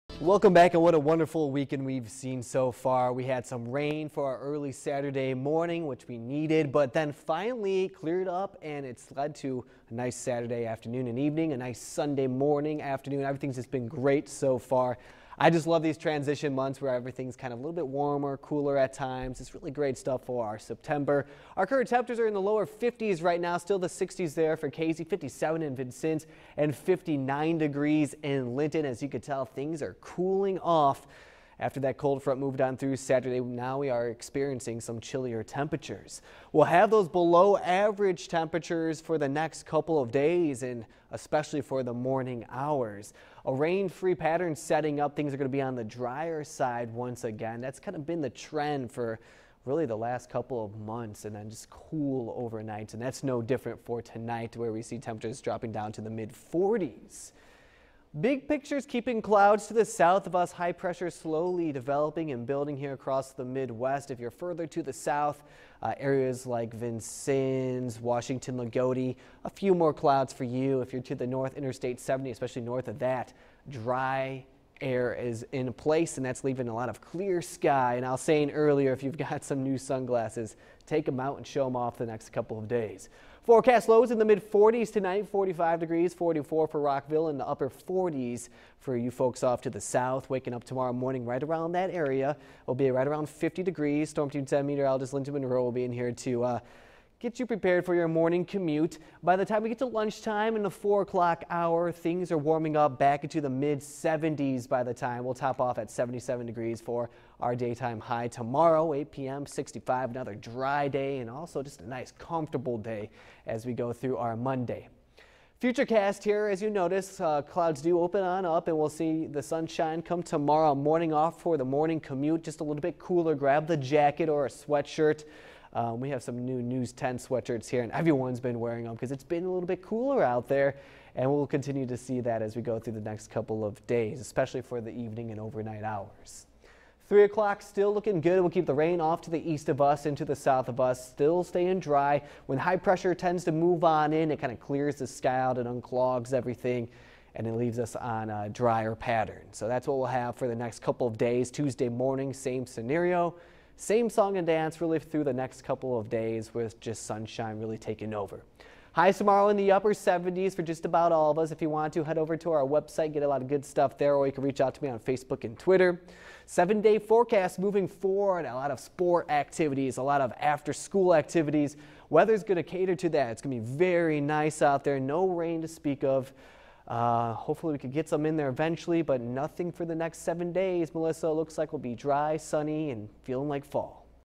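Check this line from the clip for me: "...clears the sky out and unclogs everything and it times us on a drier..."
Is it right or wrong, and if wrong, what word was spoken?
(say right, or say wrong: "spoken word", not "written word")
wrong: "leaves", not "times".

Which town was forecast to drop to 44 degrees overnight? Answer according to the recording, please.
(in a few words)
Rockville.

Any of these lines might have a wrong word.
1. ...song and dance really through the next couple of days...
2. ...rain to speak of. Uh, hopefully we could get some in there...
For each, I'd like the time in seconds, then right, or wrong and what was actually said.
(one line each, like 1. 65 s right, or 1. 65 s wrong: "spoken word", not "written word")
1. 154 s right
2. 175 s right.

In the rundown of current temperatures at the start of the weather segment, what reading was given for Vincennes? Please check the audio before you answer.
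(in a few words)
57.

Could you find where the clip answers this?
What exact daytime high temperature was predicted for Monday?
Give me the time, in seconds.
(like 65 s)
105 s.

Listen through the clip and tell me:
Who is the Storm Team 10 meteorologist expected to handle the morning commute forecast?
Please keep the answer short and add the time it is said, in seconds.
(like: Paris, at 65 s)
Linda Monroe, at 95 s.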